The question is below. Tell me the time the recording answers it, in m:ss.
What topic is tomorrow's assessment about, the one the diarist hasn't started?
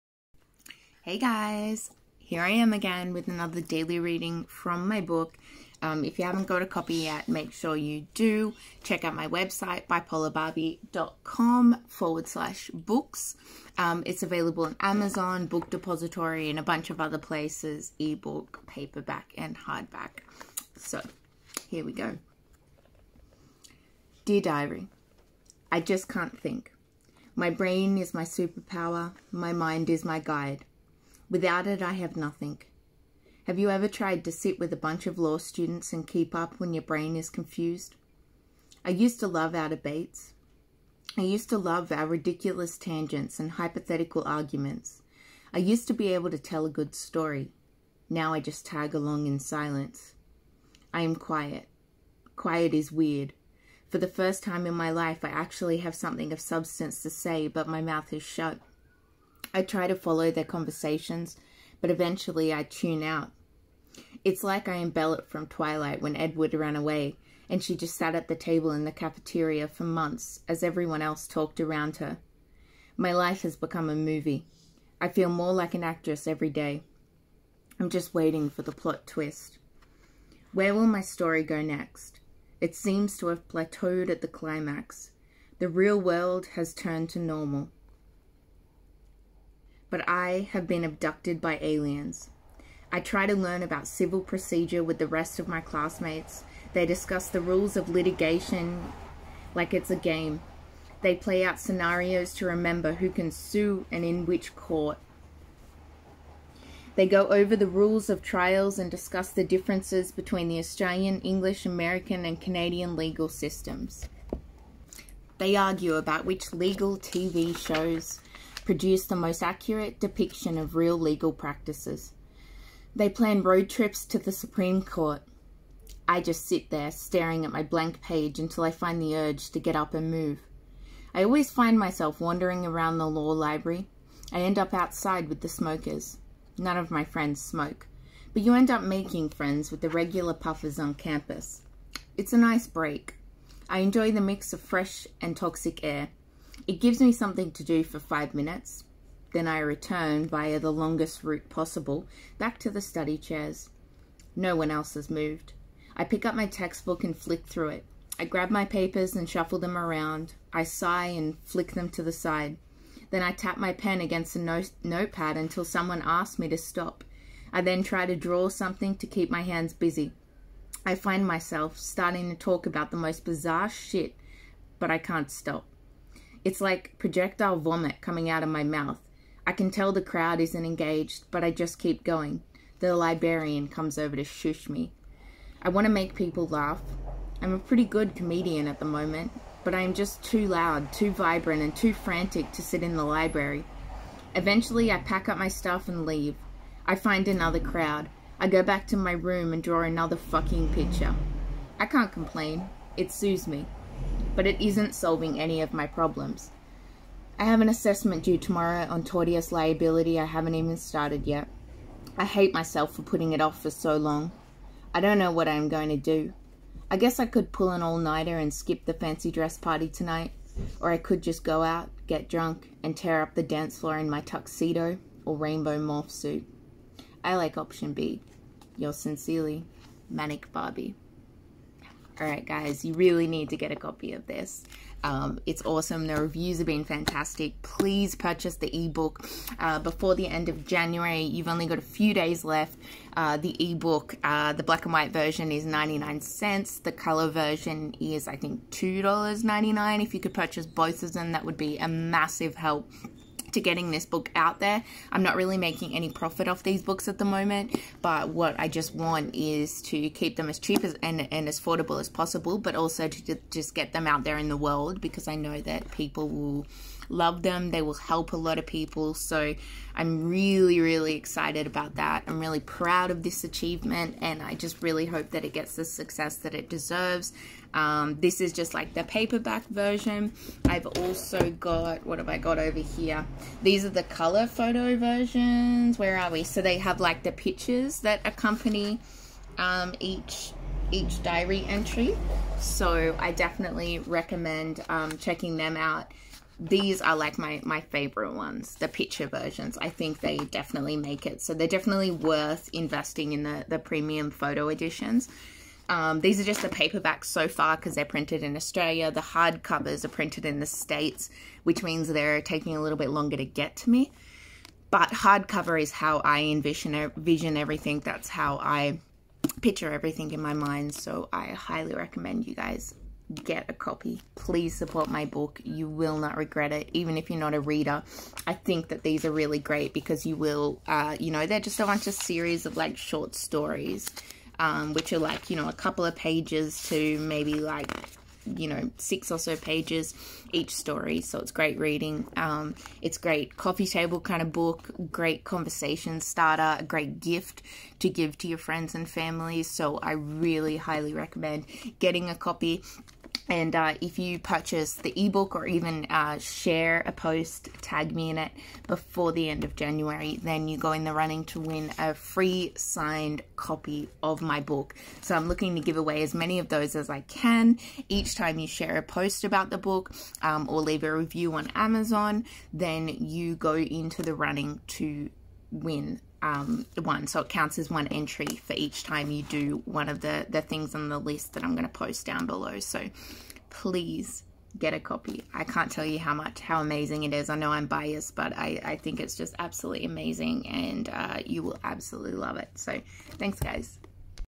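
3:29.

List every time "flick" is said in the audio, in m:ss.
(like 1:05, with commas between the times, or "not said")
2:37, 2:41.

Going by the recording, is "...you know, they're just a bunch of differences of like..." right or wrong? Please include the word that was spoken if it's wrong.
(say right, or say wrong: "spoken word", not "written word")
wrong: "series", not "differences".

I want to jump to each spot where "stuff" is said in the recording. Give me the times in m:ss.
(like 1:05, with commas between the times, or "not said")
3:15.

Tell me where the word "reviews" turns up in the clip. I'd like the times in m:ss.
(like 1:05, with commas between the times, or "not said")
3:56, 6:11.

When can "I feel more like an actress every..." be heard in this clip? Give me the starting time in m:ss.
1:15.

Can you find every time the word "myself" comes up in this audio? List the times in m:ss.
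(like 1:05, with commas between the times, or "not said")
2:11, 2:51, 3:32.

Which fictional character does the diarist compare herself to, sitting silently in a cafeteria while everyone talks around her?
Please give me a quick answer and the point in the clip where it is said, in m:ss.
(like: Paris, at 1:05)
Bella, at 1:04.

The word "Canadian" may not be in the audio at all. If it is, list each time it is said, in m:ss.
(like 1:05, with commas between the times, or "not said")
1:52.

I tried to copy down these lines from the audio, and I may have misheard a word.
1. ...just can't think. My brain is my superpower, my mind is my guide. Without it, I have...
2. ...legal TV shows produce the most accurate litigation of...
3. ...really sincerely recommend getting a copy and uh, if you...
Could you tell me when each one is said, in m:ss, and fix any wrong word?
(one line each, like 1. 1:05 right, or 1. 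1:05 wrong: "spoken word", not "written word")
1. 0:25 right
2. 1:56 wrong: "depiction", not "litigation"
3. 5:50 wrong: "highly", not "sincerely".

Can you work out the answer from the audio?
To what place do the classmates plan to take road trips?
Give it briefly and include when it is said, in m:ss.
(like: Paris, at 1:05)
the Supreme Court, at 2:04.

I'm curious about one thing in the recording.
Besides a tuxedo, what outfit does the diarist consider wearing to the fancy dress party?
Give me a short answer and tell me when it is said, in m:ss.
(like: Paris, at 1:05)
rainbow morph suit, at 3:45.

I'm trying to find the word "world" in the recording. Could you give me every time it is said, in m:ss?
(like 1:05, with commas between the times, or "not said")
1:25, 4:24.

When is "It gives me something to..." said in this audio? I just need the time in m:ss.
2:26.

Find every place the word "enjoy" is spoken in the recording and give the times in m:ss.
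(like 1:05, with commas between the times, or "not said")
2:23.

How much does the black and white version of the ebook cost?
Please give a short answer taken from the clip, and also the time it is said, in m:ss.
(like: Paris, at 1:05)
99 cents, at 4:05.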